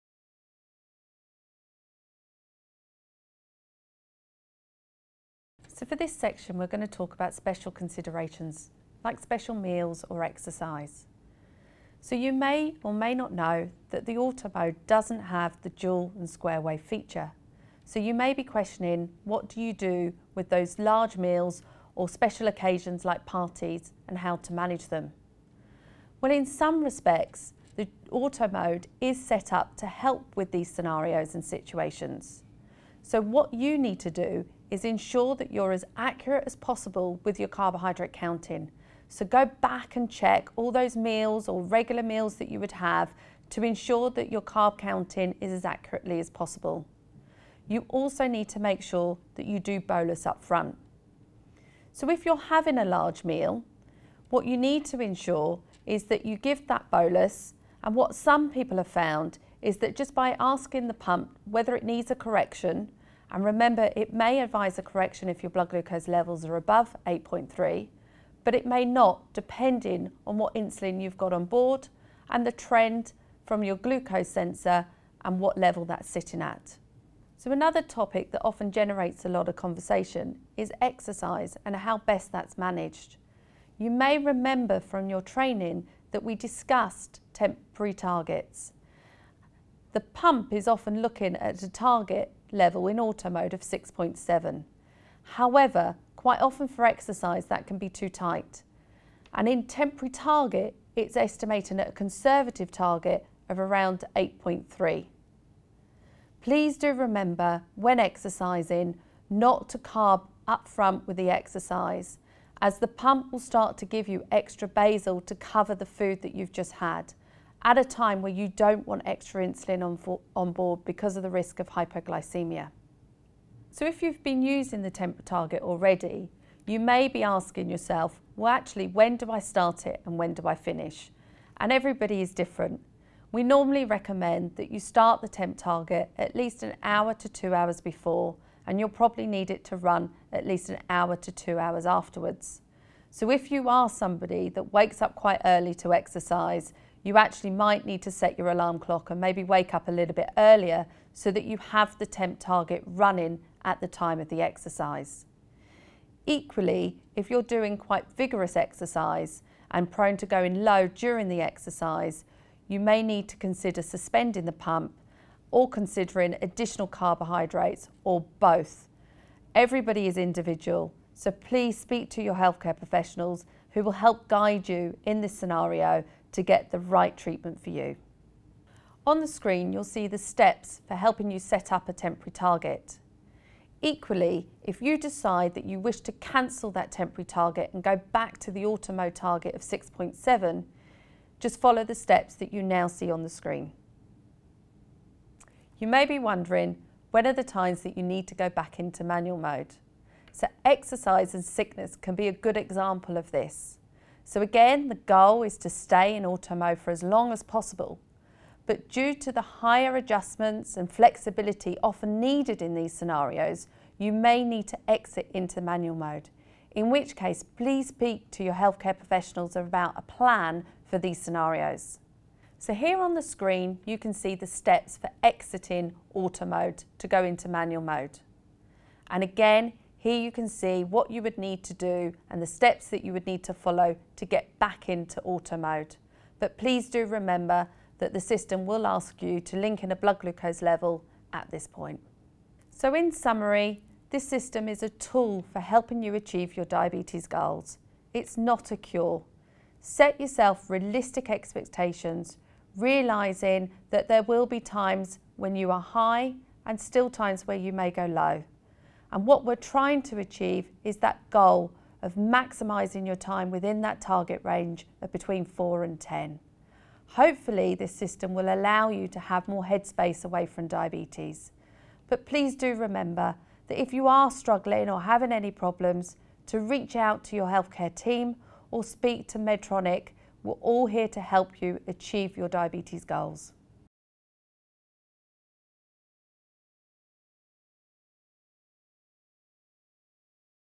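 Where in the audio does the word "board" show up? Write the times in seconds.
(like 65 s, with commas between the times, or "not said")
71 s, 120 s.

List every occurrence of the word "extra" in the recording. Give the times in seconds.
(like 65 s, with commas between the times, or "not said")
114 s, 119 s.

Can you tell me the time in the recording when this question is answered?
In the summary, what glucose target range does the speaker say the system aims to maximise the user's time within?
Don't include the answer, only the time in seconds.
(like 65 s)
265 s.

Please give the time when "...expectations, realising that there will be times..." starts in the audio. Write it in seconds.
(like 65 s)
251 s.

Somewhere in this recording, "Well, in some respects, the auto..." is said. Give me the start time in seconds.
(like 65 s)
26 s.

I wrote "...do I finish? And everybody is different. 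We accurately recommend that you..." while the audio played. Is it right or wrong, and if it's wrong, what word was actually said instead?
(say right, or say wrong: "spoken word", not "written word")
wrong: "normally", not "accurately".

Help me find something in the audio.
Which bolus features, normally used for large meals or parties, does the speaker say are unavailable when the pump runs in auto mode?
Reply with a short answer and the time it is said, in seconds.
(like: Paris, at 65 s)
Dual and square wave, at 15 s.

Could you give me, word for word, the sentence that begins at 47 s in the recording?
You also need to make sure that you do bolus up front.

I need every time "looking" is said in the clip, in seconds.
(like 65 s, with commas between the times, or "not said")
91 s.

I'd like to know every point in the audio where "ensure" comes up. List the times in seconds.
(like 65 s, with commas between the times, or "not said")
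34 s, 43 s, 55 s.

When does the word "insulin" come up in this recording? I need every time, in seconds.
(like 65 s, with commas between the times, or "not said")
70 s, 119 s.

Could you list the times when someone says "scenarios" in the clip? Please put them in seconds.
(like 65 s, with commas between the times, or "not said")
30 s, 175 s, 212 s, 221 s.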